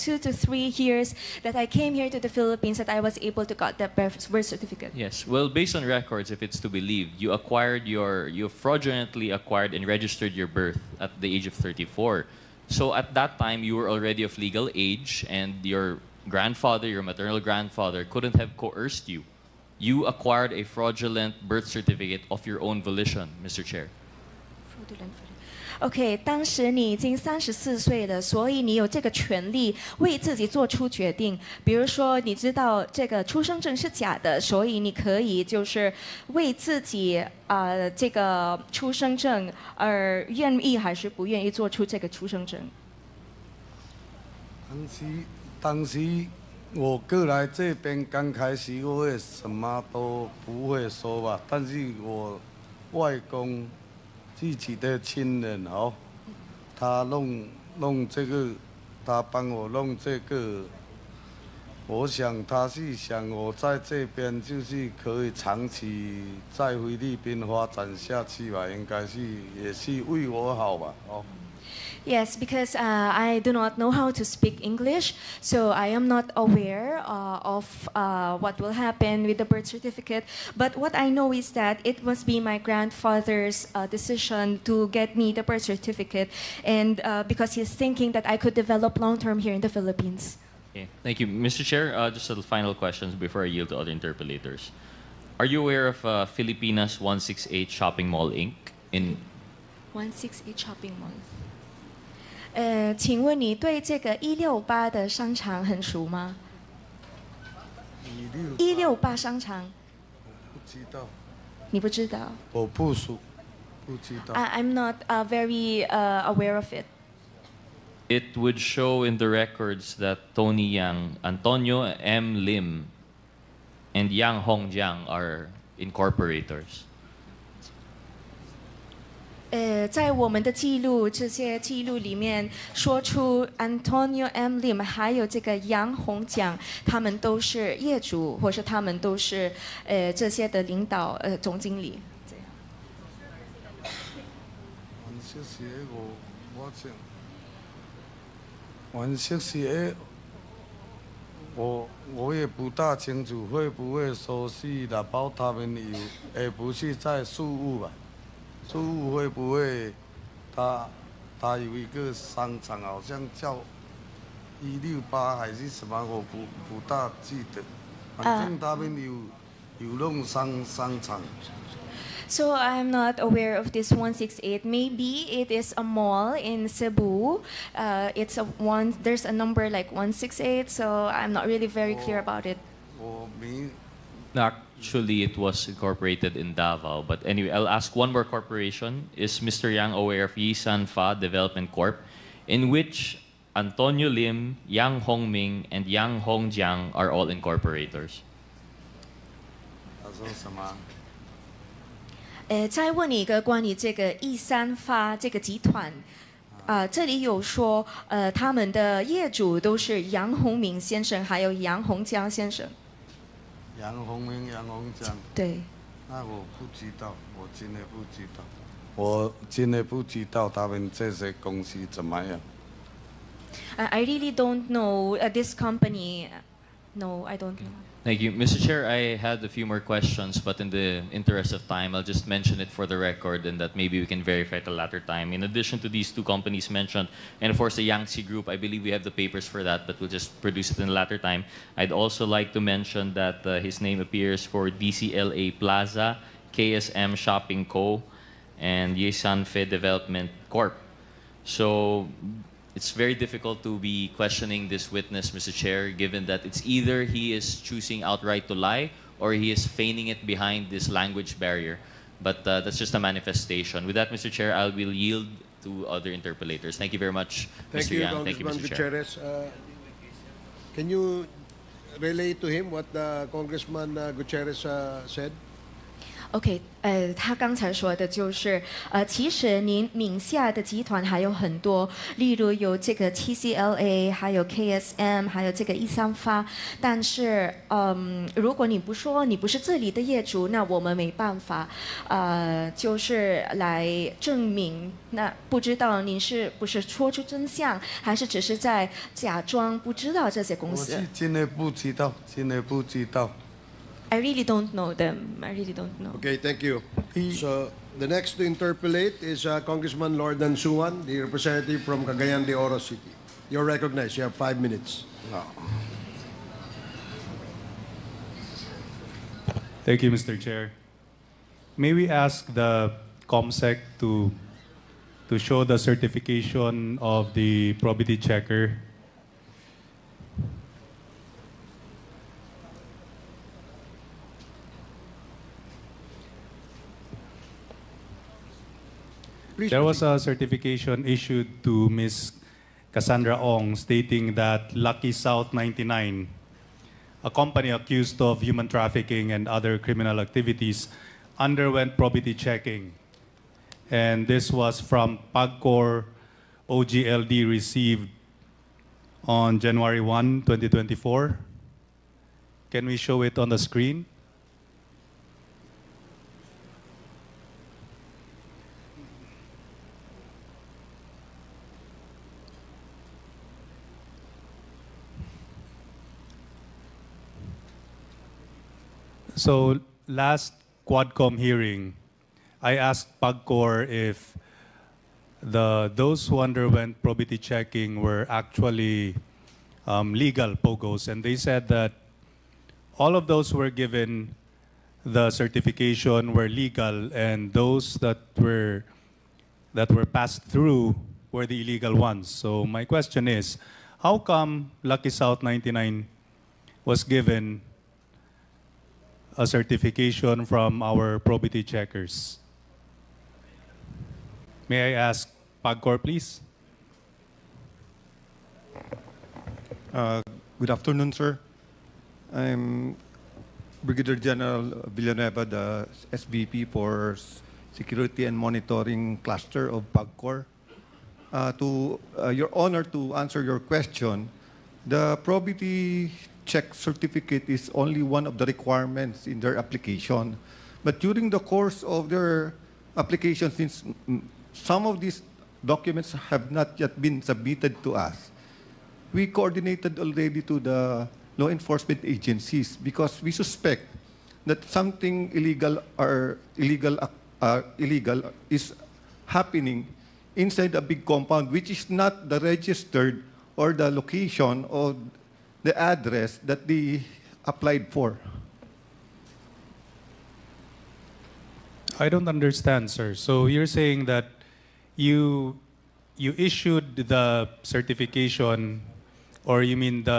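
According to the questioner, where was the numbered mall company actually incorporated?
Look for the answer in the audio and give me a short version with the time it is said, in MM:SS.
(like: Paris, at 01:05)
Davao, at 03:06.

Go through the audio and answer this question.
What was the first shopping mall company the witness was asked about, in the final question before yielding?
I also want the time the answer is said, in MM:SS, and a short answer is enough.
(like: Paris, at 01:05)
Filipinas 168 Shopping Mall Inc., at 01:36.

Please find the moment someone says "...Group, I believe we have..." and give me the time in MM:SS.
03:58.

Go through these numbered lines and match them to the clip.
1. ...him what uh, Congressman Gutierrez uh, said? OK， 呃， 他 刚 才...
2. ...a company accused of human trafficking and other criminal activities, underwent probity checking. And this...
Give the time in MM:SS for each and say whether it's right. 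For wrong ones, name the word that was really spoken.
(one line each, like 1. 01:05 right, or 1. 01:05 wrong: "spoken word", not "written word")
1. 04:32 right
2. 05:47 right.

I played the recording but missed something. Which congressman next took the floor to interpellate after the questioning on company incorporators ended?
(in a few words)
Lordan Suan.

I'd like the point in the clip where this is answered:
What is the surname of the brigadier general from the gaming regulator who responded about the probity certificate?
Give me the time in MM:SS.
07:04.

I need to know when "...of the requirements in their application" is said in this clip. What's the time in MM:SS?
07:18.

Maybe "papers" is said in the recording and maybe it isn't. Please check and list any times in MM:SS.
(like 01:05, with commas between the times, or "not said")
03:59.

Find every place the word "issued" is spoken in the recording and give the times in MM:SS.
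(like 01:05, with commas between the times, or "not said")
05:41, 07:56.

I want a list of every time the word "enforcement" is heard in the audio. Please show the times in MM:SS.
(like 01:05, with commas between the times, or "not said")
07:31.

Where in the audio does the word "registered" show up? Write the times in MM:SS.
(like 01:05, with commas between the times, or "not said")
00:09, 07:42.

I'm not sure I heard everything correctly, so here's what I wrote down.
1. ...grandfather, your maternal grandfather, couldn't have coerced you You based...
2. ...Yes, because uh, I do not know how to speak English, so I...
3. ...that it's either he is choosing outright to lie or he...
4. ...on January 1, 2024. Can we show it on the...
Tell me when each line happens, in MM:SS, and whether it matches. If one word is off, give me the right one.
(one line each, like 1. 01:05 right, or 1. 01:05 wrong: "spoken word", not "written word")
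1. 00:16 wrong: "acquired", not "based"
2. 01:12 right
3. 04:16 right
4. 05:59 right.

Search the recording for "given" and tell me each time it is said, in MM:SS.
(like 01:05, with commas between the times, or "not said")
04:15, 06:33, 06:47.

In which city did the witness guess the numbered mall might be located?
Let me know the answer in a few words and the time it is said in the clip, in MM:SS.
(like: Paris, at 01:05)
Cebu, at 02:56.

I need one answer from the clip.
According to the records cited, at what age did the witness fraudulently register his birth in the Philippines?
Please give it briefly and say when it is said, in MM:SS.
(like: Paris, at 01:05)
34, at 00:11.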